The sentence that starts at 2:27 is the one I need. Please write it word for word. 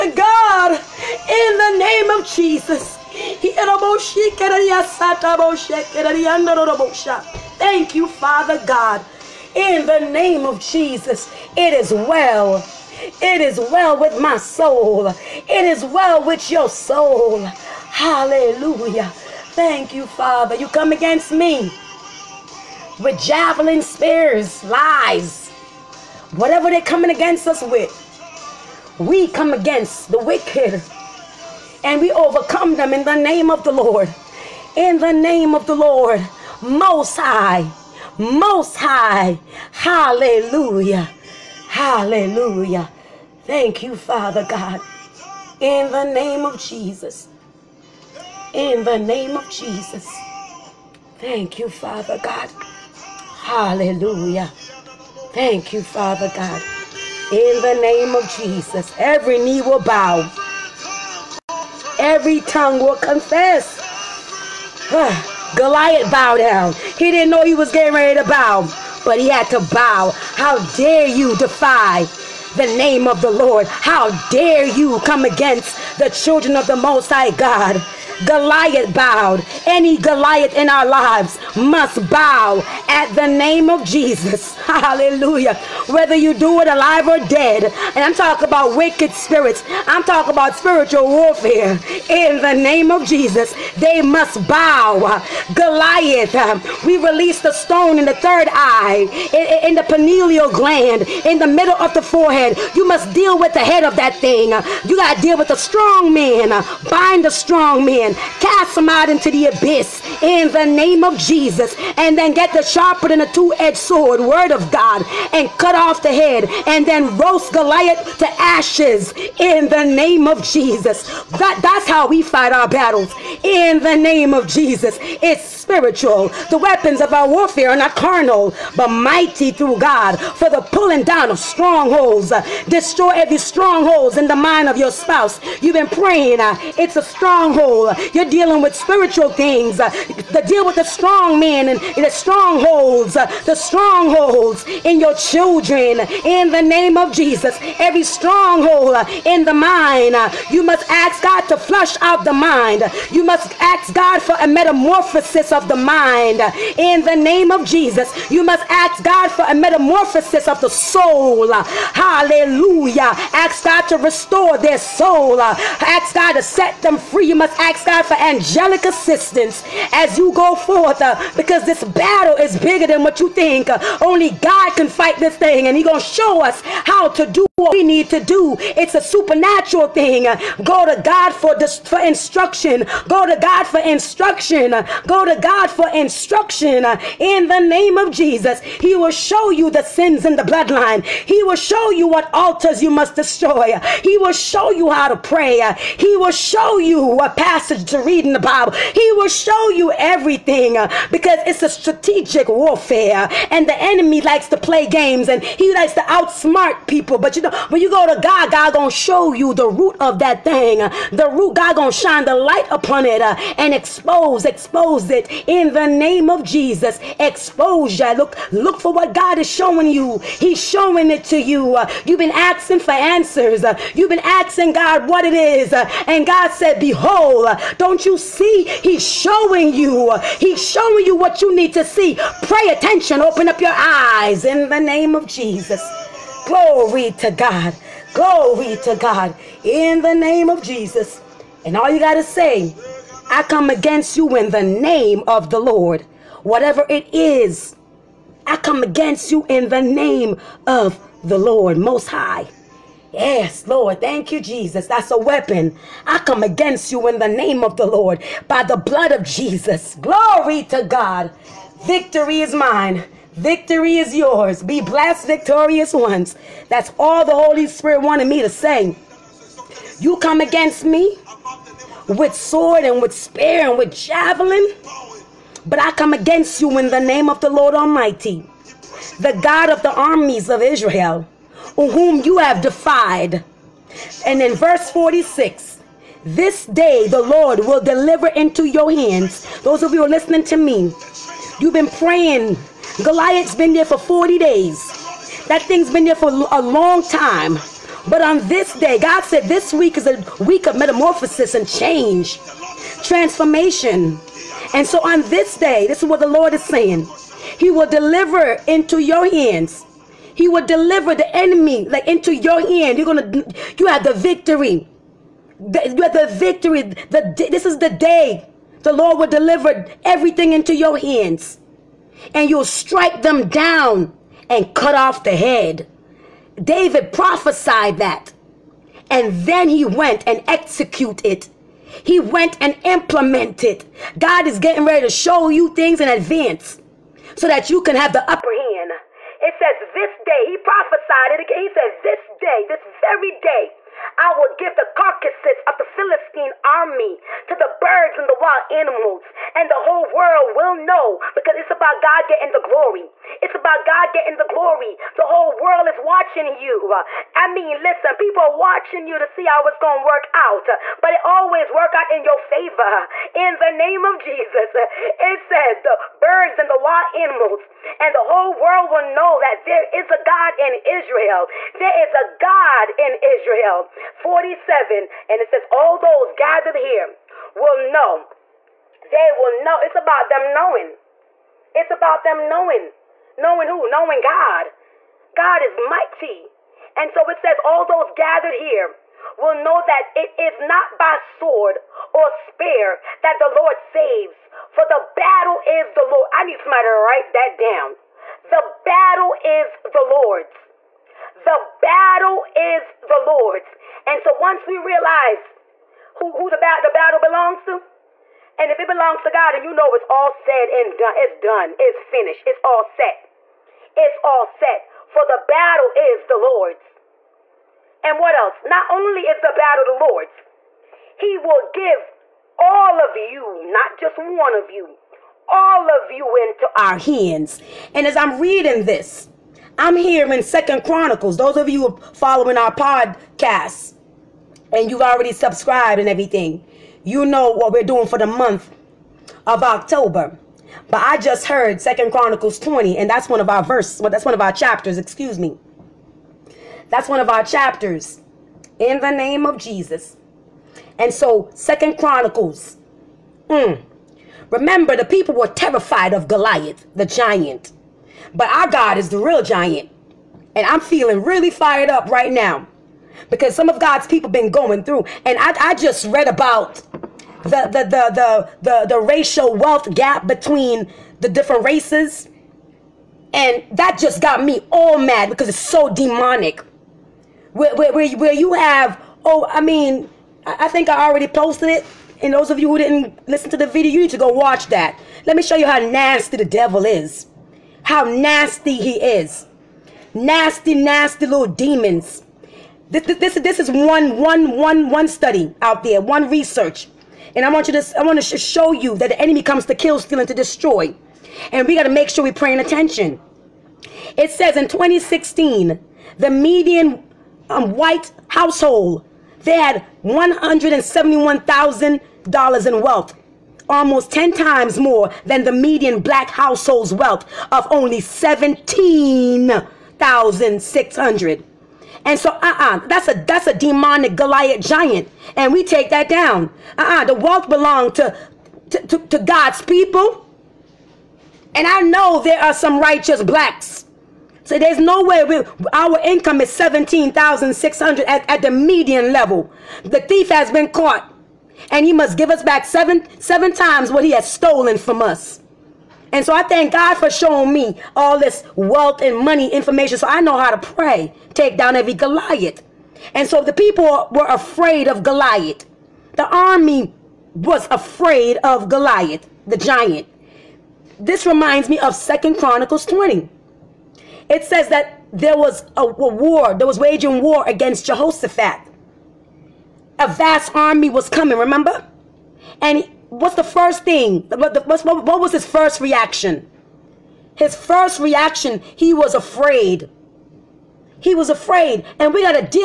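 Every stronghold uh, in the mind, uh, you must ask God to flush out the mind.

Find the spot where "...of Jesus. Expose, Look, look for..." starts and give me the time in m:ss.
3:36.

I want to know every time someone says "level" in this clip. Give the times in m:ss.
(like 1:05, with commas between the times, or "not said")
8:59.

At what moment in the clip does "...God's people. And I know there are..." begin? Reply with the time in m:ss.
8:49.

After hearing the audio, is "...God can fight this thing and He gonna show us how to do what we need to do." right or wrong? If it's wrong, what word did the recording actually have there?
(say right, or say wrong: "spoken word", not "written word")
right.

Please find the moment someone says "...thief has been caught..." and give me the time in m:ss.
9:00.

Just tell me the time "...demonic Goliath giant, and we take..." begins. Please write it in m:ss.
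8:43.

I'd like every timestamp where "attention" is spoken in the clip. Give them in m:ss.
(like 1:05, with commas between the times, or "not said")
3:52, 8:22.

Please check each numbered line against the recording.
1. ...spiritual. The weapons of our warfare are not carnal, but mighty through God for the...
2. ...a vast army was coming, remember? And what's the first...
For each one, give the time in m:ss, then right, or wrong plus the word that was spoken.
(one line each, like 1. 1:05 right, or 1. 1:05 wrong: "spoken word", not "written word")
1. 2:05 right
2. 9:29 right.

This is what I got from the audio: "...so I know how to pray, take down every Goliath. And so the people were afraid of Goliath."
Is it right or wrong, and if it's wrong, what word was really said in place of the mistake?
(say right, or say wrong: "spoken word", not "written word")
right.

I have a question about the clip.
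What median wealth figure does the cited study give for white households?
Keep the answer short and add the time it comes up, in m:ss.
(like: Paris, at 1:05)
$171,000, at 8:30.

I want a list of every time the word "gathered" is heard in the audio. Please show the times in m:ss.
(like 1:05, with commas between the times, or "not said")
6:16, 6:28.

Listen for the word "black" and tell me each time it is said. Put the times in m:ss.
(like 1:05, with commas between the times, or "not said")
8:35, 8:53.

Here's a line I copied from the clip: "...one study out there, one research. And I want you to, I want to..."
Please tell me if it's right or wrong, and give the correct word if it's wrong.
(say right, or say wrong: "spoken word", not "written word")
right.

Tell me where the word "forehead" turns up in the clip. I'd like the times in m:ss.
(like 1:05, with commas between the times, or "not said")
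1:42.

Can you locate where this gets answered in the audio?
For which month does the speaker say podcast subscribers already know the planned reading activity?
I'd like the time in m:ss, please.
7:19.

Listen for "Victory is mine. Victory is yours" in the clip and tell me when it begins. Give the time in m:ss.
4:21.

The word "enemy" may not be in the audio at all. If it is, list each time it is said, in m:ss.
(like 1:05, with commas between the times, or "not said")
3:23, 5:11, 8:19.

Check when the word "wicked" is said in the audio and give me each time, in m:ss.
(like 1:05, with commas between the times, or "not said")
0:30, 1:28.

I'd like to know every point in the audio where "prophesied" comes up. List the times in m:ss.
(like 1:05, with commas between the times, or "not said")
5:27, 5:40.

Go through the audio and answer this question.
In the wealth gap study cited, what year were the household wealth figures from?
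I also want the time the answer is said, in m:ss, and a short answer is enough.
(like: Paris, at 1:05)
2016, at 8:24.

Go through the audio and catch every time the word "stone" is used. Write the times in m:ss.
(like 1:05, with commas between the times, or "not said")
1:37.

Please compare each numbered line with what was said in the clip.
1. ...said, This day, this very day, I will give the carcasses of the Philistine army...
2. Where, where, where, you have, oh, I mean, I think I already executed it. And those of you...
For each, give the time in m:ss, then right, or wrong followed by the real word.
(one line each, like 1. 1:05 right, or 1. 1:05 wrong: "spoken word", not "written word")
1. 5:41 right
2. 7:57 wrong: "posted", not "executed".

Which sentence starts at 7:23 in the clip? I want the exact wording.
Well, that's one of our chapters, excuse me.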